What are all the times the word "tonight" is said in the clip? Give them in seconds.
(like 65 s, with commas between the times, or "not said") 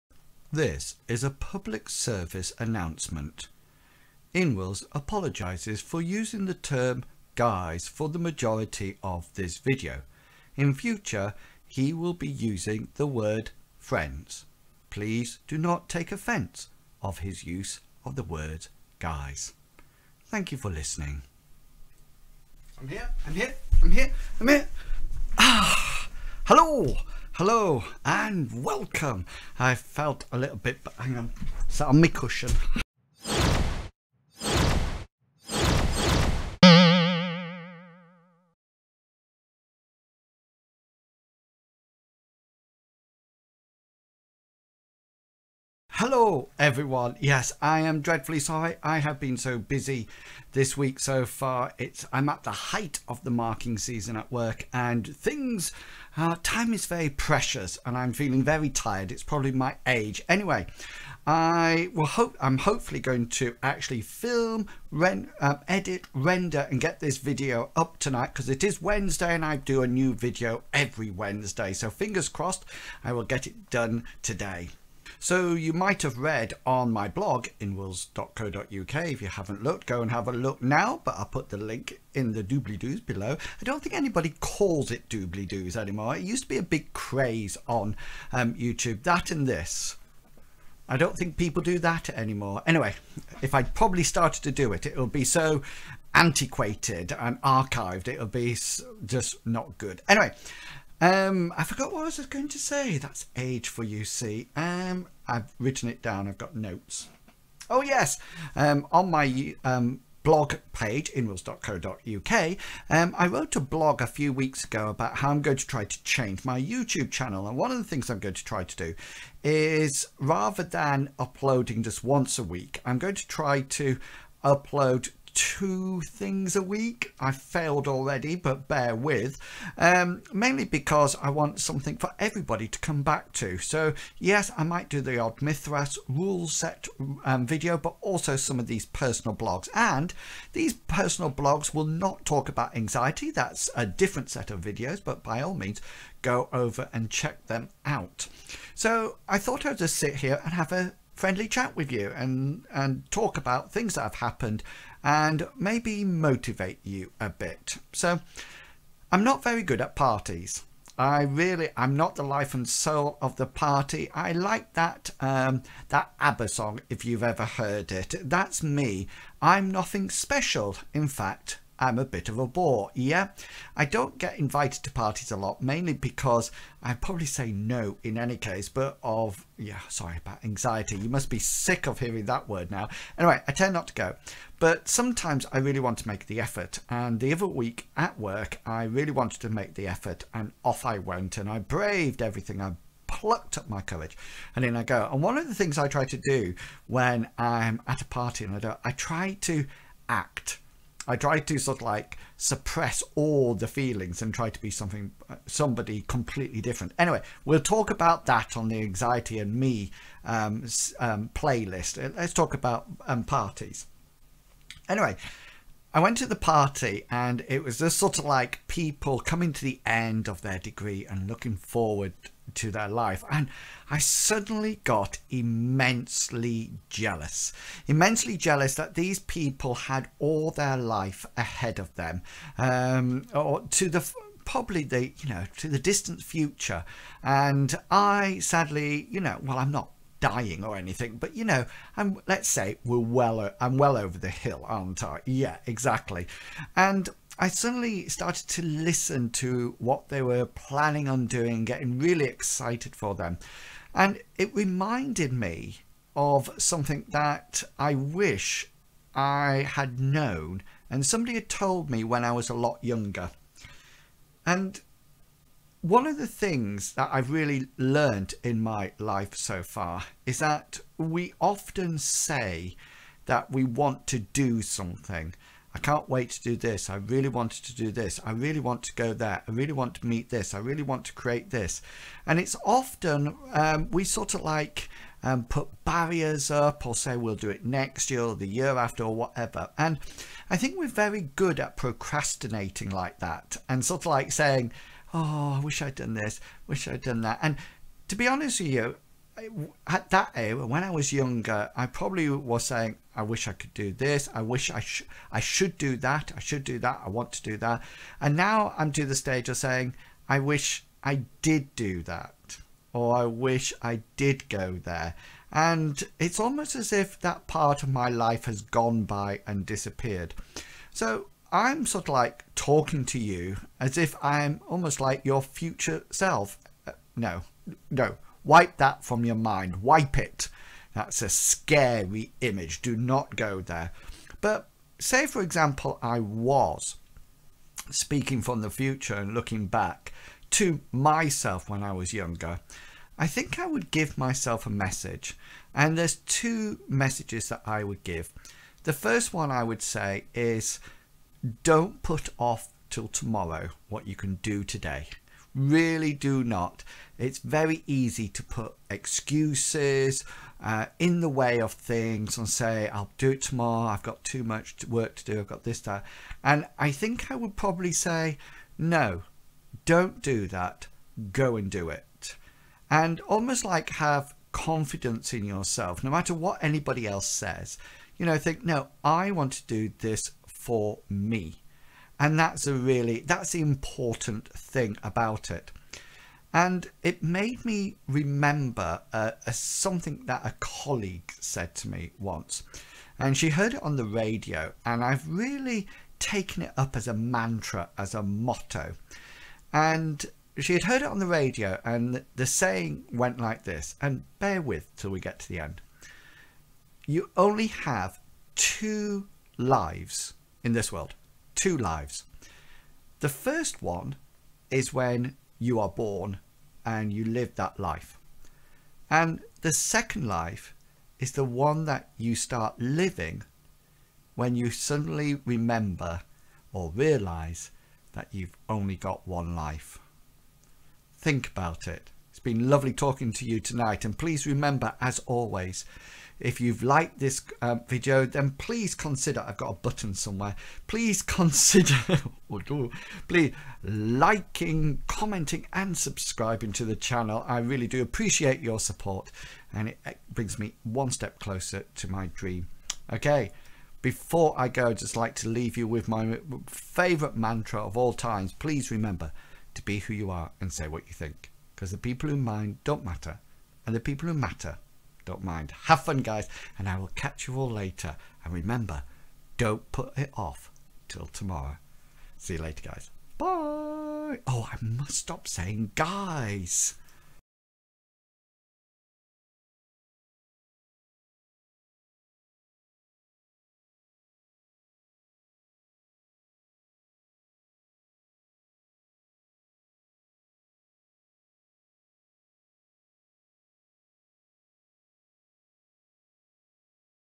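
67 s, 433 s.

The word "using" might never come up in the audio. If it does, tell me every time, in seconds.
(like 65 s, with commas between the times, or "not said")
6 s, 12 s.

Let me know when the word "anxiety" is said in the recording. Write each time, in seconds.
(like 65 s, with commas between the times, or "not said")
142 s, 180 s, 208 s.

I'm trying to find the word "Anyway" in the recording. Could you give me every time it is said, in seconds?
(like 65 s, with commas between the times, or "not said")
60 s, 92 s, 100 s, 183 s, 206 s, 214 s.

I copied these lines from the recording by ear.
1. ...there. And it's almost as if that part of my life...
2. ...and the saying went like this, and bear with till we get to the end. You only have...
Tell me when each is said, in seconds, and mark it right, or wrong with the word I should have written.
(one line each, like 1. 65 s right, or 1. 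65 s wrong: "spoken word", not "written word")
1. 314 s right
2. 401 s right.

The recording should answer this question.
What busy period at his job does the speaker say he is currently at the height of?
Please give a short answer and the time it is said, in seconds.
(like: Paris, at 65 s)
marking season, at 53 s.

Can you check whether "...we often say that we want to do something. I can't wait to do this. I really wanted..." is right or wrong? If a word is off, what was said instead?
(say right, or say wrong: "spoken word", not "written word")
right.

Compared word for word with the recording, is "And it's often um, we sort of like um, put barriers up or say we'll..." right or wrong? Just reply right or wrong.
right.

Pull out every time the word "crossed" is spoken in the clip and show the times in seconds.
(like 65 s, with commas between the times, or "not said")
72 s.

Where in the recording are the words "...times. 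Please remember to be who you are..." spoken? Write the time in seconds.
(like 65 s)
458 s.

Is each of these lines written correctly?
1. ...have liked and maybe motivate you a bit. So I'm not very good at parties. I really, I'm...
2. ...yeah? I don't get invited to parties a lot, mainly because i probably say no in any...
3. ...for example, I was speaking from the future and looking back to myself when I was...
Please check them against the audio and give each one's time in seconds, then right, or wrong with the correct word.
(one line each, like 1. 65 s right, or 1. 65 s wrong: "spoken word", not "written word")
1. 154 s wrong: "happened", not "liked"
2. 172 s right
3. 335 s right.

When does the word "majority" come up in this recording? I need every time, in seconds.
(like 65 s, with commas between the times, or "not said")
8 s.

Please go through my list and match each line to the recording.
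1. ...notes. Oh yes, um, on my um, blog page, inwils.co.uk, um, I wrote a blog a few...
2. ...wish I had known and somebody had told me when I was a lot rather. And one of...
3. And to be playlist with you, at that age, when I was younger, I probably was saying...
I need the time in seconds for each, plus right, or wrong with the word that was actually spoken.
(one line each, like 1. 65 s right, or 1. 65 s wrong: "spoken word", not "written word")
1. 106 s right
2. 257 s wrong: "younger", not "rather"
3. 297 s wrong: "honest", not "playlist".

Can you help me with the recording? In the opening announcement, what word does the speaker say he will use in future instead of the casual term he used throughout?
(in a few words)
friends.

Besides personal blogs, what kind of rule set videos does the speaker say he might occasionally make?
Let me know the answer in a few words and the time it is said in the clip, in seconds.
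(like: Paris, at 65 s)
Mythras, at 135 s.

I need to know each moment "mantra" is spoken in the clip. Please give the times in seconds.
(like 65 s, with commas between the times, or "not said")
397 s, 457 s.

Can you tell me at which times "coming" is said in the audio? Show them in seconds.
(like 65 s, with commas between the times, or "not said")
219 s.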